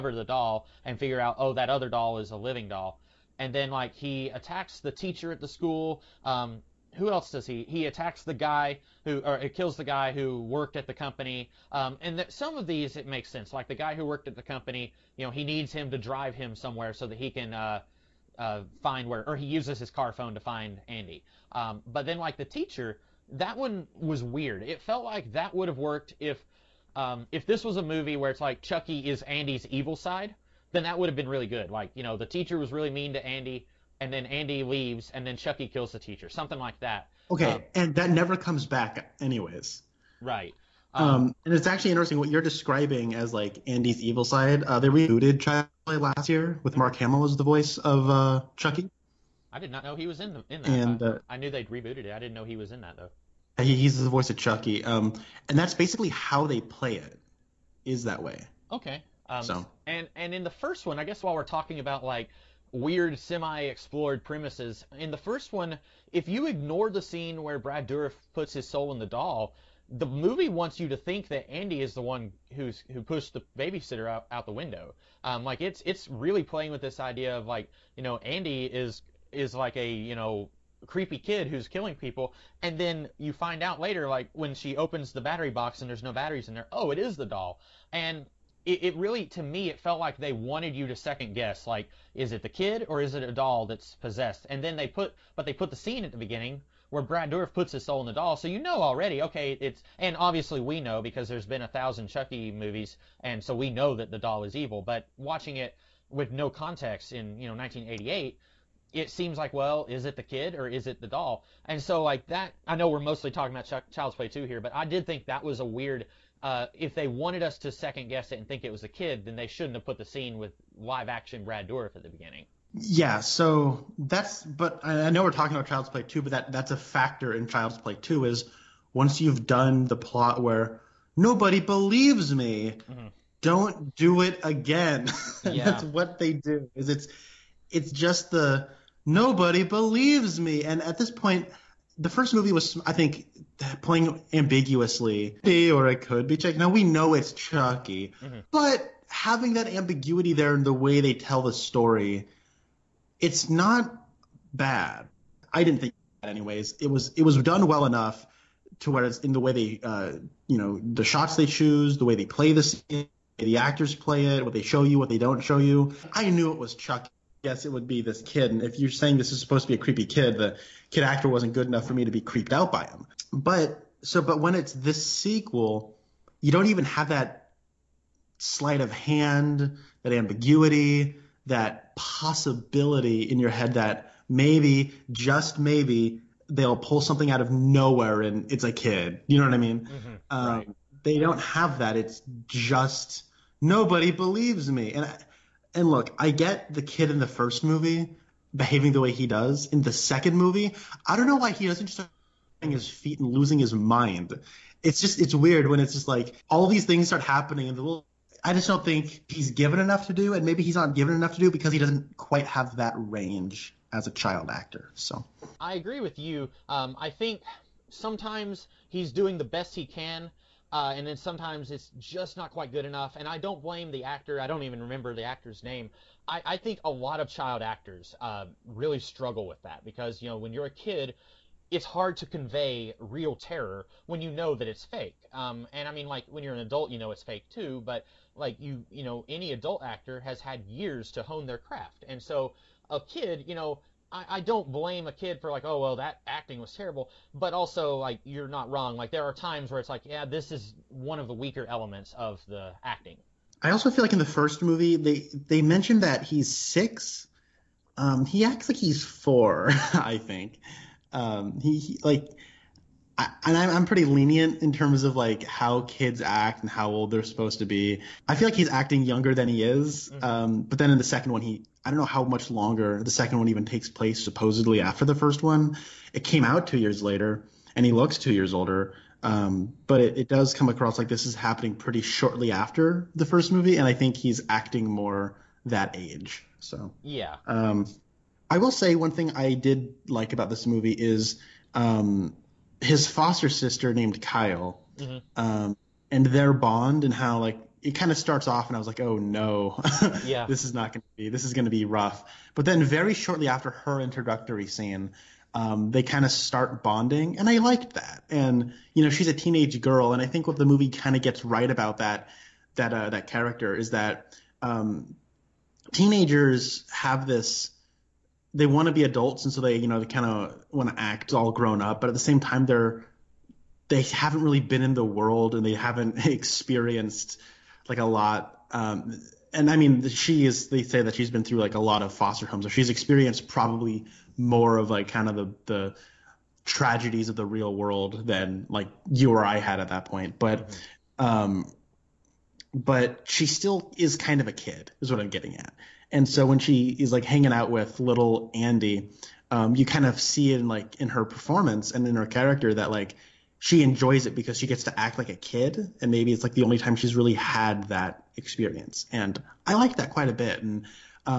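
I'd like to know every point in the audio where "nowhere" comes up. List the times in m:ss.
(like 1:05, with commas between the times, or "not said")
3:07.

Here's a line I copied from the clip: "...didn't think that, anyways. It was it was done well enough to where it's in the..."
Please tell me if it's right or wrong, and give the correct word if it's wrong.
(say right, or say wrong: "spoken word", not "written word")
right.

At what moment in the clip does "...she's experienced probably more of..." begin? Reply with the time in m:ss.
5:32.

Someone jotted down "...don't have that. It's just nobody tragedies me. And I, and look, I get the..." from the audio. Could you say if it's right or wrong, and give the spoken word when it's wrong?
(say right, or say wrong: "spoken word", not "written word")
wrong: "believes", not "tragedies".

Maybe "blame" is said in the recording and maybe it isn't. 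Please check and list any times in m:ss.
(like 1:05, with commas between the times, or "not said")
3:43, 4:04.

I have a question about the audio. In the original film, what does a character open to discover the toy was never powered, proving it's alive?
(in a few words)
battery box.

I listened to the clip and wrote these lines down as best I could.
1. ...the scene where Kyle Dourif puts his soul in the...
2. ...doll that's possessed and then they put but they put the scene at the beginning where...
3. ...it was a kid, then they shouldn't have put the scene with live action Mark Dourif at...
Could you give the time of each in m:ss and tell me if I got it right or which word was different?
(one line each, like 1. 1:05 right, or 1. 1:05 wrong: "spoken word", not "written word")
1. 1:06 wrong: "Brad", not "Kyle"
2. 1:33 right
3. 1:58 wrong: "Brad", not "Mark".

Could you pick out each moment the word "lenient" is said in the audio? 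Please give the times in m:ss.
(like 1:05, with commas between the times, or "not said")
4:24.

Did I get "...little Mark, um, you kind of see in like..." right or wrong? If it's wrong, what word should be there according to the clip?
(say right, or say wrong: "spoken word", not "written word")
wrong: "Andy", not "Mark".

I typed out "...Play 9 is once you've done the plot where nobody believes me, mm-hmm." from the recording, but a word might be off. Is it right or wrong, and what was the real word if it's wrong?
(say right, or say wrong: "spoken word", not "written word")
wrong: "2", not "9".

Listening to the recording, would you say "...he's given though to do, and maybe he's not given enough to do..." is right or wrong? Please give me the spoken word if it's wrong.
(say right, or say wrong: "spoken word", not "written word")
wrong: "enough", not "though".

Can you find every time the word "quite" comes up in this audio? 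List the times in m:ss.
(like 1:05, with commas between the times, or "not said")
3:32, 3:42, 6:00.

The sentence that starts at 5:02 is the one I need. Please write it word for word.
But then very shortly after her introductory scene, um, they kind of start bonding, and I liked that.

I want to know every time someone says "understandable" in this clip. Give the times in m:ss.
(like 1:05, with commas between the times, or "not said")
not said.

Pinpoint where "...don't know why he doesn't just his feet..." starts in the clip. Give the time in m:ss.
3:21.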